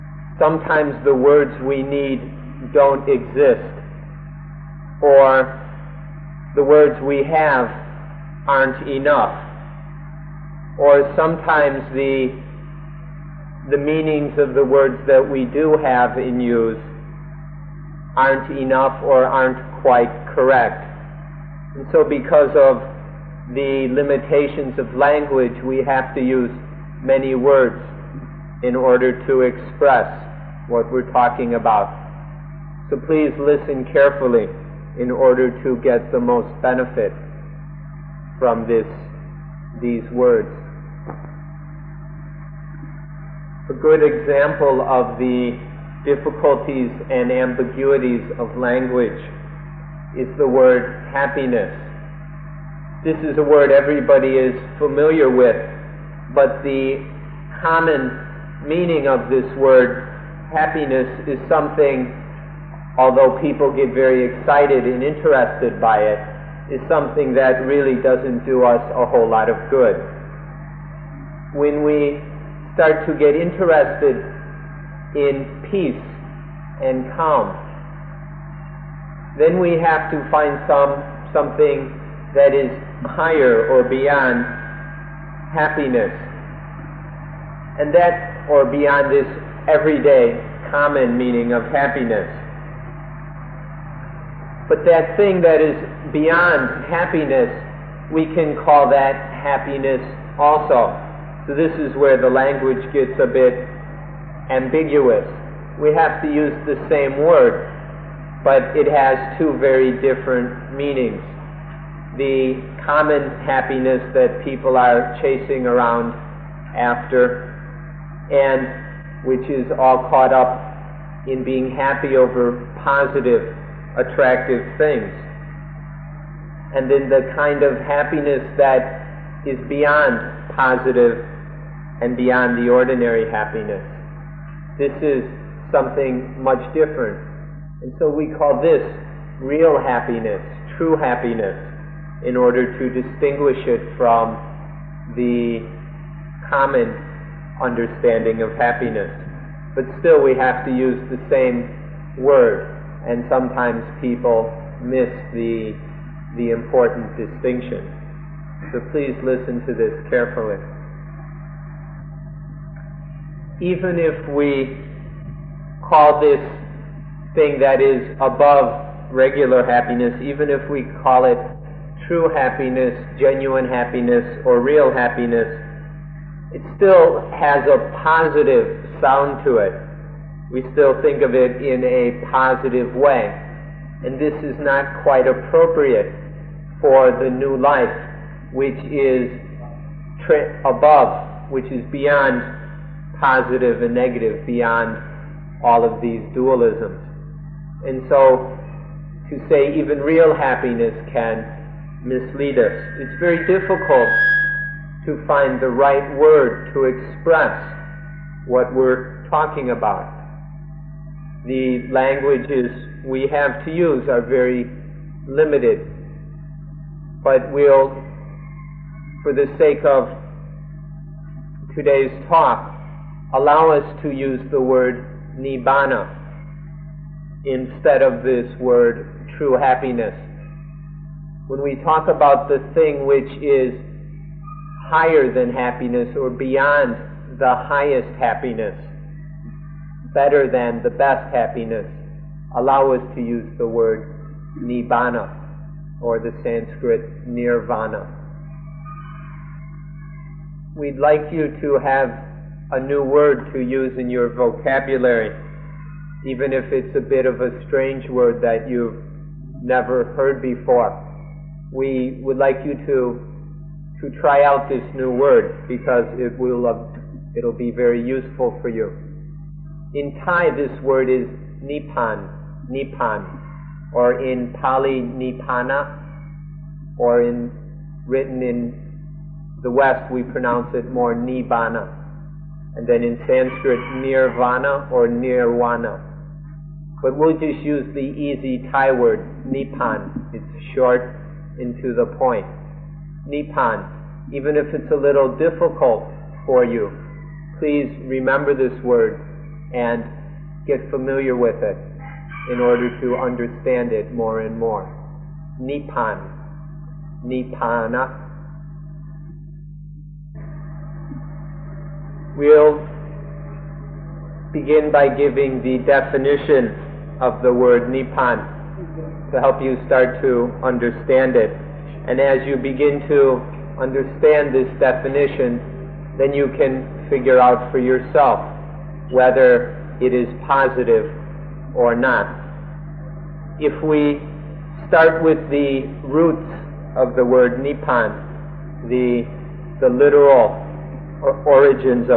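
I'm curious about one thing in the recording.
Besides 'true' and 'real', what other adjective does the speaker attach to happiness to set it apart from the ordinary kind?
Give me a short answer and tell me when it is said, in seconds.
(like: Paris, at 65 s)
genuine, at 173 s.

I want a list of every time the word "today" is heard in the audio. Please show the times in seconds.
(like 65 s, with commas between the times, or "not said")
221 s.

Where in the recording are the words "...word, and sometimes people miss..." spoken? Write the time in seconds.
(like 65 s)
152 s.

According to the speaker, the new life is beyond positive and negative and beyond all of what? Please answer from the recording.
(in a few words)
dualisms.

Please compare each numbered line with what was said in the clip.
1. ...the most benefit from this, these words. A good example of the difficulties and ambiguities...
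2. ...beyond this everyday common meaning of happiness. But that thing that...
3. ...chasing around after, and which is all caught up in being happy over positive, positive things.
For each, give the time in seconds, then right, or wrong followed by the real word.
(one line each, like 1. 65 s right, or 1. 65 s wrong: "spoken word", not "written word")
1. 36 s right
2. 88 s right
3. 115 s wrong: "attractive", not "positive".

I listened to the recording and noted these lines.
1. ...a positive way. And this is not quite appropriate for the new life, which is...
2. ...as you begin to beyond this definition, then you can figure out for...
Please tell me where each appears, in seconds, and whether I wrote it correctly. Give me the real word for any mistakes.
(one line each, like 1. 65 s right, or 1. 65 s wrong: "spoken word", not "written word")
1. 181 s right
2. 322 s wrong: "understand", not "beyond".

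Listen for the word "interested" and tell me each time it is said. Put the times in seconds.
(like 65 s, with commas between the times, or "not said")
65 s, 73 s.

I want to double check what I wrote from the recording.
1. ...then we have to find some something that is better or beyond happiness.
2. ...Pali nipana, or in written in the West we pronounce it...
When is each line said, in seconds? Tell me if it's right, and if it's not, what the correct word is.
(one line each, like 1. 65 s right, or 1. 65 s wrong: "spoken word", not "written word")
1. 79 s wrong: "higher", not "better"
2. 274 s right.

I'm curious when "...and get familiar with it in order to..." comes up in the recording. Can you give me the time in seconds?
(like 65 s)
299 s.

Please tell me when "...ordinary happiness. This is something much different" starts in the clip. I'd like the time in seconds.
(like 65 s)
132 s.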